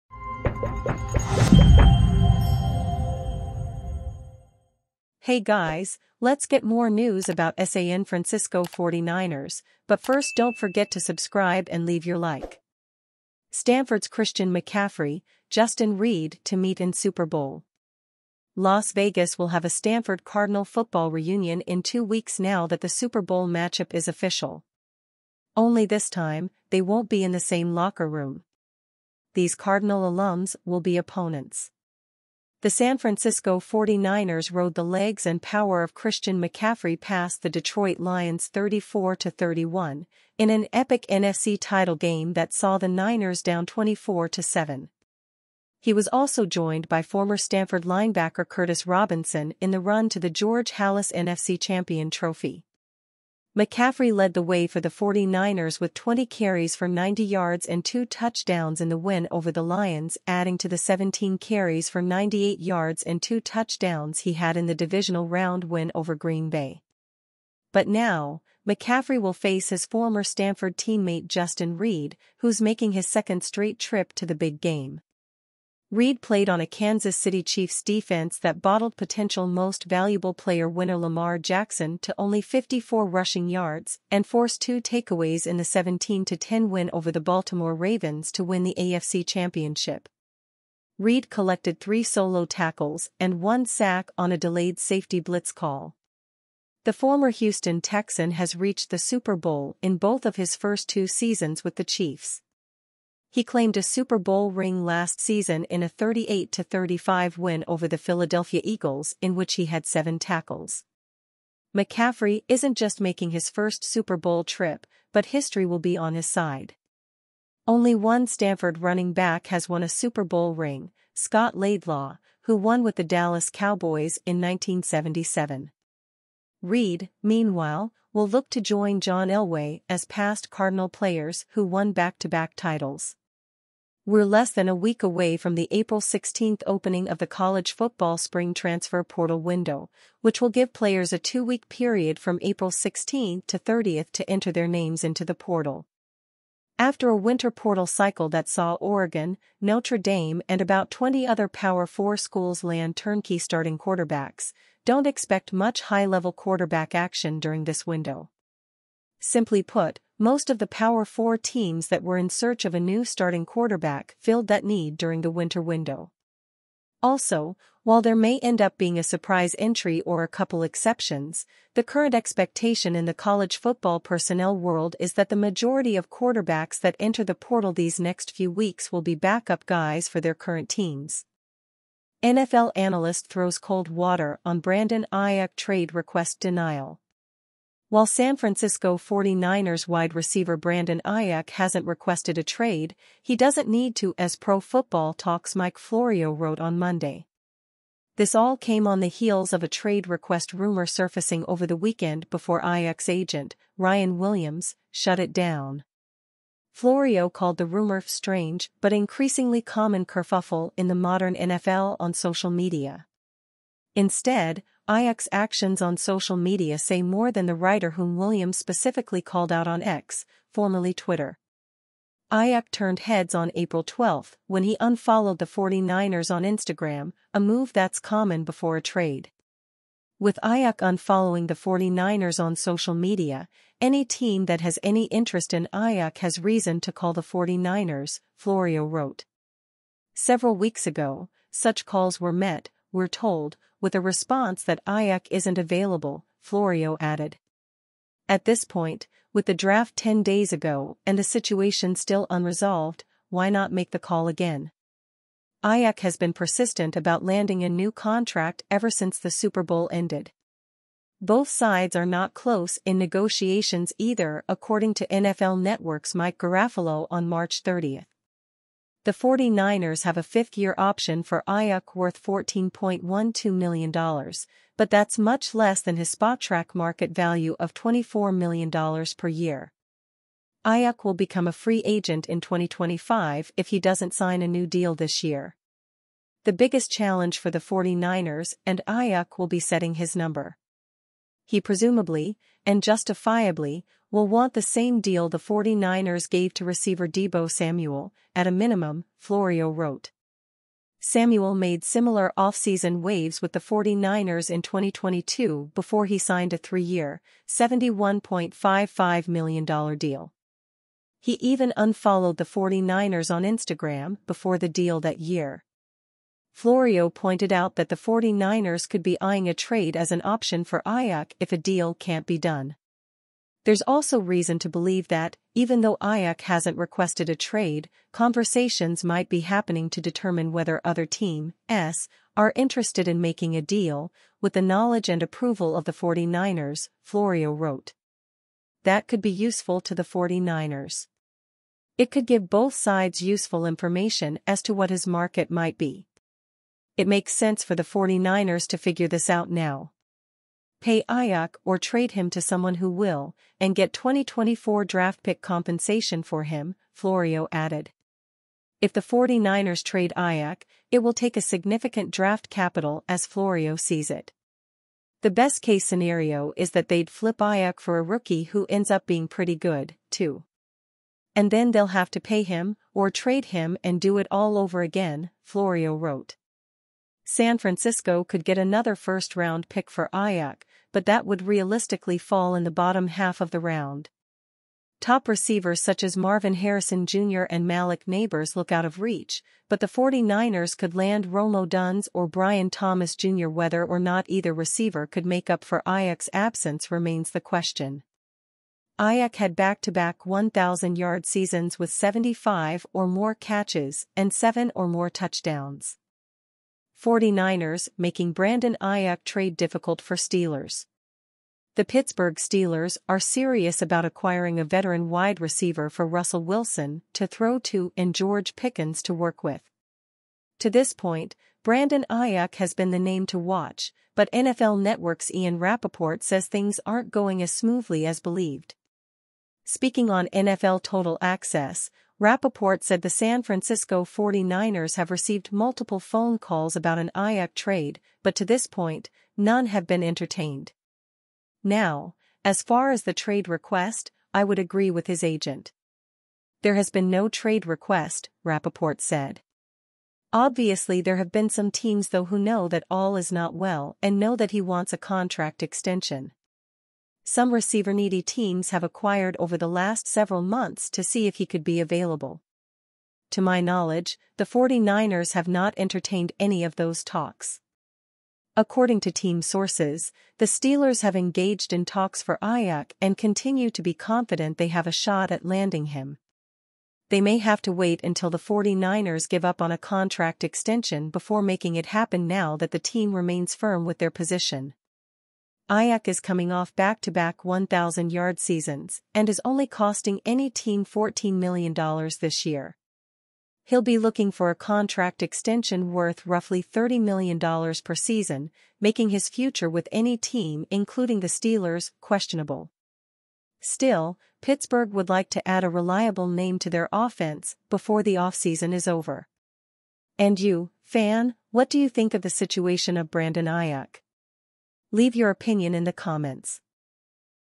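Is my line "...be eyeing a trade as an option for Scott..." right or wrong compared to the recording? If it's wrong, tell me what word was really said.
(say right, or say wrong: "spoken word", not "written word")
wrong: "Aiyuk", not "Scott".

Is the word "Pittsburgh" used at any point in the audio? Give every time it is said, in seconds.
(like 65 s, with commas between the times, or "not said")
411 s, 504 s.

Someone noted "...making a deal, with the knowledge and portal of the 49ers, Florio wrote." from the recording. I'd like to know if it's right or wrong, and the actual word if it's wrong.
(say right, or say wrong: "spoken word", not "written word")
wrong: "approval", not "portal".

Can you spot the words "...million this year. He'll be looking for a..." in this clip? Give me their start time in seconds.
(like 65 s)
491 s.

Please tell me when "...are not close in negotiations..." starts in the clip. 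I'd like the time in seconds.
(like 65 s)
261 s.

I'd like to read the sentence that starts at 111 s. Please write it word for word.
McCaffrey isn't just making his first Super Bowl trip, but history will be on his side.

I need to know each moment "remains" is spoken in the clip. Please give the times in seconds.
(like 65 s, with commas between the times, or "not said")
396 s, 483 s.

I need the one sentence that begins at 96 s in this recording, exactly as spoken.
The former Houston Texan has reached the Super Bowl in both of his first two seasons with the Chiefs.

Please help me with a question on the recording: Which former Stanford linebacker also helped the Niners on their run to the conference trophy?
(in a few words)
Curtis Robinson.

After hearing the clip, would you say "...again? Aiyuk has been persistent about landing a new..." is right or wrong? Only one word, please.
right.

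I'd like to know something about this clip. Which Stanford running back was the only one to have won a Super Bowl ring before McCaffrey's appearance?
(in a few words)
Scott Laidlaw.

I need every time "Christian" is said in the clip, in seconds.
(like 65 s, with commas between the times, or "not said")
14 s, 35 s.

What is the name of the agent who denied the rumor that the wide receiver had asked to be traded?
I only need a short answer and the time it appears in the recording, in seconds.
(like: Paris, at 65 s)
Ryan Williams, at 203 s.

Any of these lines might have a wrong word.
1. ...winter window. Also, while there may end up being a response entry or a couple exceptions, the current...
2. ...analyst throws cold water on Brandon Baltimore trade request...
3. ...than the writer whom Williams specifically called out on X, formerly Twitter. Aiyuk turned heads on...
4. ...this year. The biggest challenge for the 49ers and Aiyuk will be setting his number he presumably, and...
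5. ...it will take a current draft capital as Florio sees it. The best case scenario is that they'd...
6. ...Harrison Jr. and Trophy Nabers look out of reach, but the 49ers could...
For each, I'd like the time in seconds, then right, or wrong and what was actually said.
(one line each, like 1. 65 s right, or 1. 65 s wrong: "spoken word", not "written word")
1. 165 s wrong: "surprise", not "response"
2. 182 s wrong: "Aiyuk", not "Baltimore"
3. 217 s right
4. 284 s right
5. 360 s wrong: "significant", not "current"
6. 386 s wrong: "Malik", not "Trophy".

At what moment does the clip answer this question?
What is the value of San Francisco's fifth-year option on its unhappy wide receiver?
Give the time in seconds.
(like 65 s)
272 s.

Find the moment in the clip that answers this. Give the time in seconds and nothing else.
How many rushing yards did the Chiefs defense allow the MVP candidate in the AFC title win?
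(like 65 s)
82 s.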